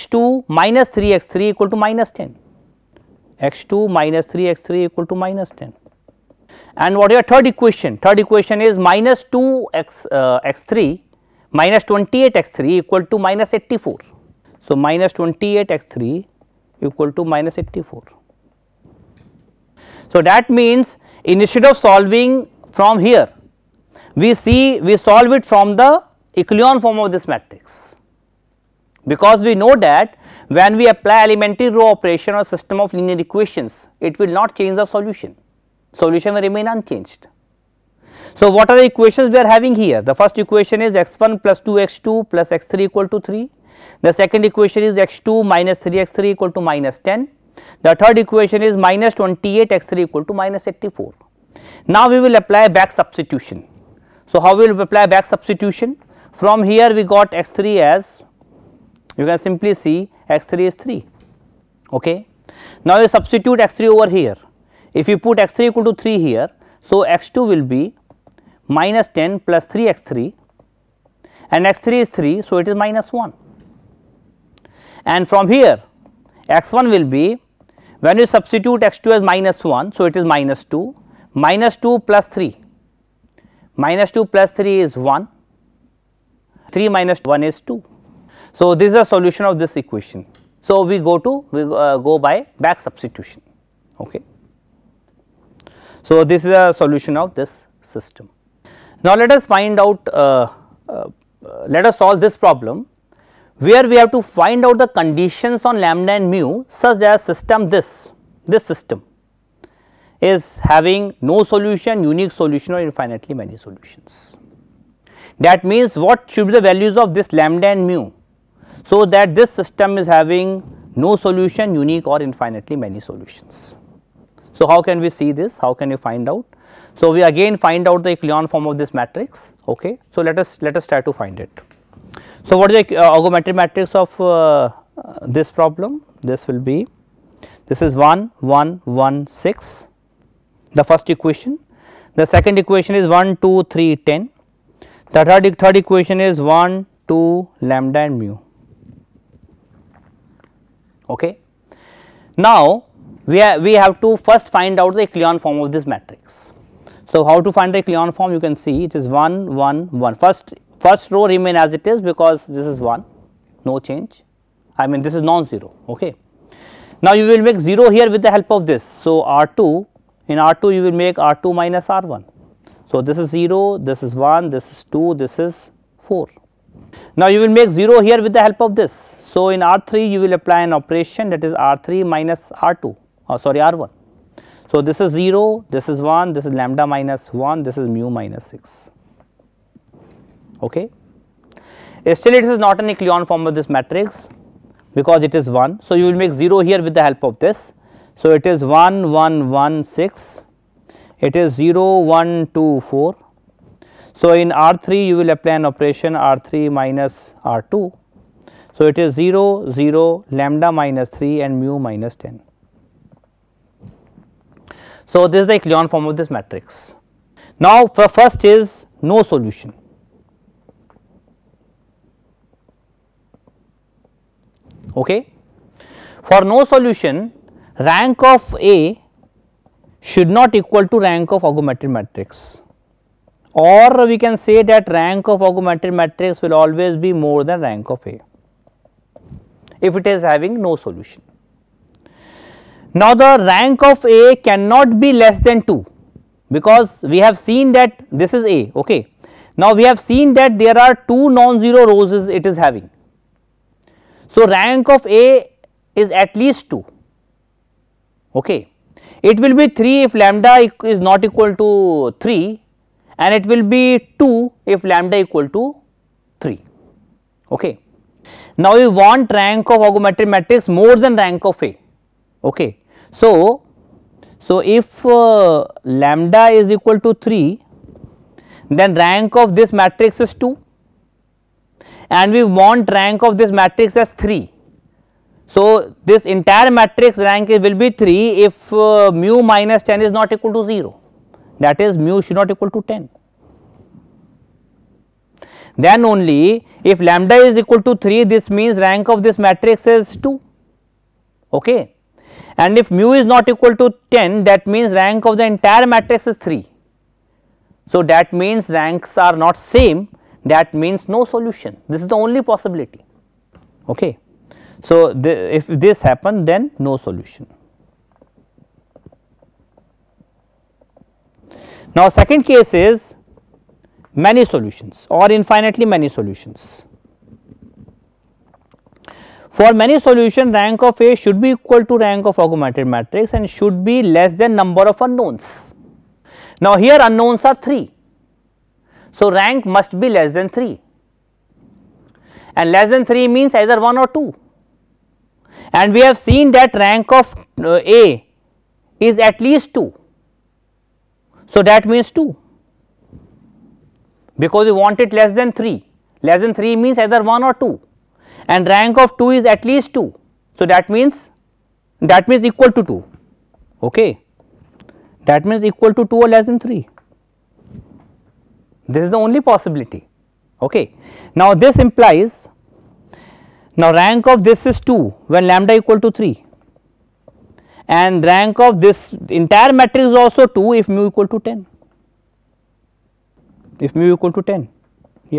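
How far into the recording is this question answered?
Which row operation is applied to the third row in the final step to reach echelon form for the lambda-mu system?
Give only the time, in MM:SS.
03:26.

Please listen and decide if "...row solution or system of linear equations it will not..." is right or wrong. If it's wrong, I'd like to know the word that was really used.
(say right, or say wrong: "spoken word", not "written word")
wrong: "operation", not "solution".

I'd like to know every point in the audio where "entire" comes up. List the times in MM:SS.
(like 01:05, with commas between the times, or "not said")
04:46, 05:05, 06:19.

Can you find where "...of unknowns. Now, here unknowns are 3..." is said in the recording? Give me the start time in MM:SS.
05:34.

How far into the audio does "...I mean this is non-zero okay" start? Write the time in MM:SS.
02:44.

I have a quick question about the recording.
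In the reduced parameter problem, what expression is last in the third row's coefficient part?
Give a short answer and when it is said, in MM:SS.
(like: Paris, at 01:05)
lambda minus 3, at 03:30.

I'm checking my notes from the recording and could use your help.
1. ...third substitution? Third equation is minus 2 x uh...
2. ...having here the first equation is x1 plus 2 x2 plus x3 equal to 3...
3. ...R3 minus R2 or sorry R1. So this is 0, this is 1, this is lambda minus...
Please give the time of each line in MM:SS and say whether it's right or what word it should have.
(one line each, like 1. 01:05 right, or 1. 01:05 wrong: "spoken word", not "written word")
1. 00:07 wrong: "equation", not "substitution"
2. 00:39 right
3. 03:01 right.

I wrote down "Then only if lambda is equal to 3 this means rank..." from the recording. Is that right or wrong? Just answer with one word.
right.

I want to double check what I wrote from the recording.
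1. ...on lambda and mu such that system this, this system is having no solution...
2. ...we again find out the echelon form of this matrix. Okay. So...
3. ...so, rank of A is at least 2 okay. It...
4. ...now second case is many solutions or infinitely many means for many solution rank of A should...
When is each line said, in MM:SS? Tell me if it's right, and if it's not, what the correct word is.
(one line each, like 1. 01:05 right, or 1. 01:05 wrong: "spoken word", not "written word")
1. 01:45 right
2. 02:07 right
3. 04:14 right
4. 05:21 wrong: "solutions", not "means".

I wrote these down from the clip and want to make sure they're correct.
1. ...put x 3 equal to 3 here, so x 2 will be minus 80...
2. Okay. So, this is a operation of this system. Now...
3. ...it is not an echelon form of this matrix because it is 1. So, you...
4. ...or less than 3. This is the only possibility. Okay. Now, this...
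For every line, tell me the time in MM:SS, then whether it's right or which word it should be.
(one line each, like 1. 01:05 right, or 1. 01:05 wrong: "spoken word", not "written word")
1. 01:05 wrong: "10", not "80"
2. 01:33 wrong: "solution", not "operation"
3. 03:12 right
4. 06:06 right.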